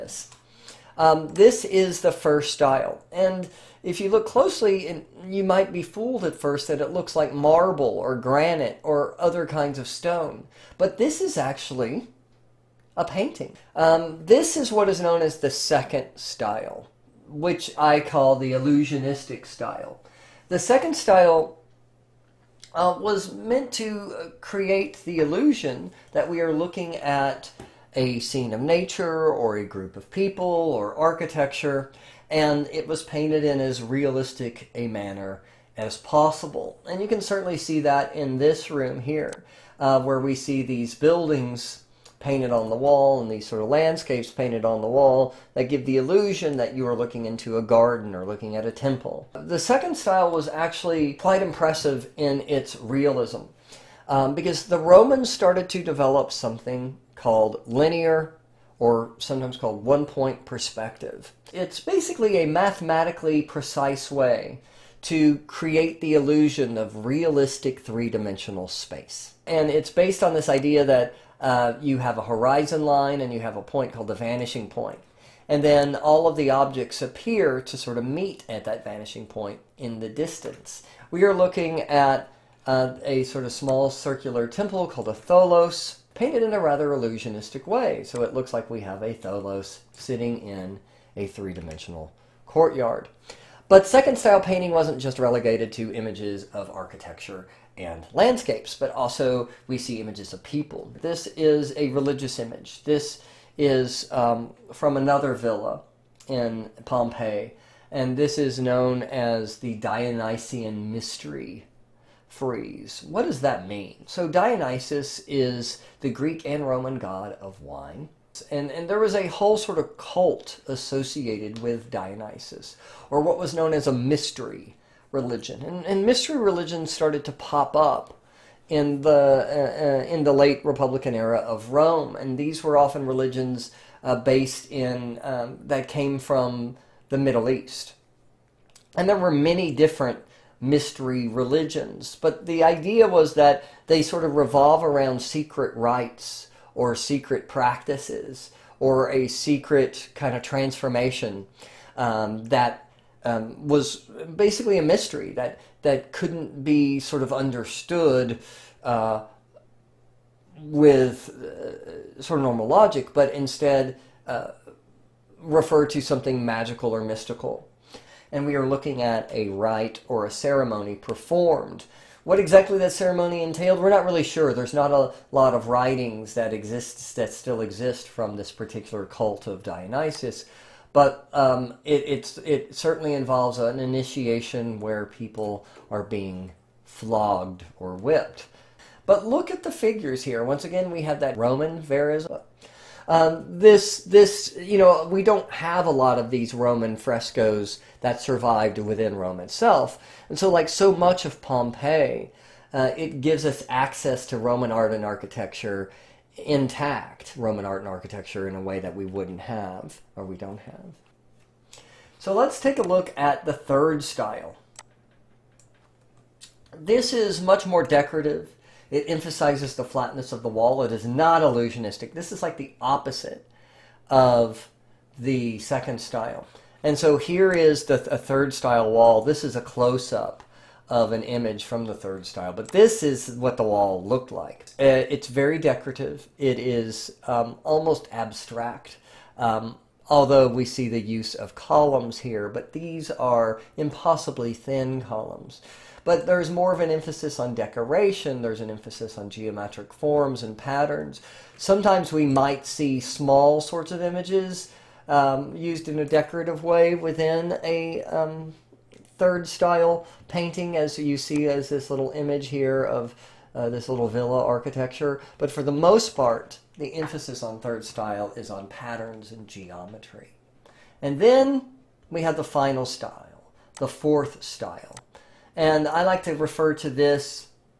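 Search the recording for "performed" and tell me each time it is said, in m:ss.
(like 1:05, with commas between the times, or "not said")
2:50.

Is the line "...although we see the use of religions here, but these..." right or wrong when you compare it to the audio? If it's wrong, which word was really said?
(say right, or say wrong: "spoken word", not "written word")
wrong: "columns", not "religions".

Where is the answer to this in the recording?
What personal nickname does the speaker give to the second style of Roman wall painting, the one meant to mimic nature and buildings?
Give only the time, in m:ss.
0:18.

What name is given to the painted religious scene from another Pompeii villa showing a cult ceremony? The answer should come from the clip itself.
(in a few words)
Dionysian Mystery frieze.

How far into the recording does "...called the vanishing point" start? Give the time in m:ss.
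1:13.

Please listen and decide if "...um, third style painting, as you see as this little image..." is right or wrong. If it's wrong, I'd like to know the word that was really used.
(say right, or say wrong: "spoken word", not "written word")
right.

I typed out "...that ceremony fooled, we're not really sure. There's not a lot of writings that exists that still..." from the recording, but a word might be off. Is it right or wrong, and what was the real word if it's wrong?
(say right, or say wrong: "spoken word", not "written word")
wrong: "entailed", not "fooled".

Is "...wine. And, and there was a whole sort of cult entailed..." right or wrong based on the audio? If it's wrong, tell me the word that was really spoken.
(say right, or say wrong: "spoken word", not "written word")
wrong: "associated", not "entailed".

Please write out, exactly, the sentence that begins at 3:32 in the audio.
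So let's take a look at the third style.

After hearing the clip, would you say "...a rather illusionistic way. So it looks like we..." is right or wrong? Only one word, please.
right.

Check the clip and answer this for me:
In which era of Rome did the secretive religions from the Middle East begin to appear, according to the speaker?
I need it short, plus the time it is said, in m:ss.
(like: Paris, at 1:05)
late Republican era, at 2:10.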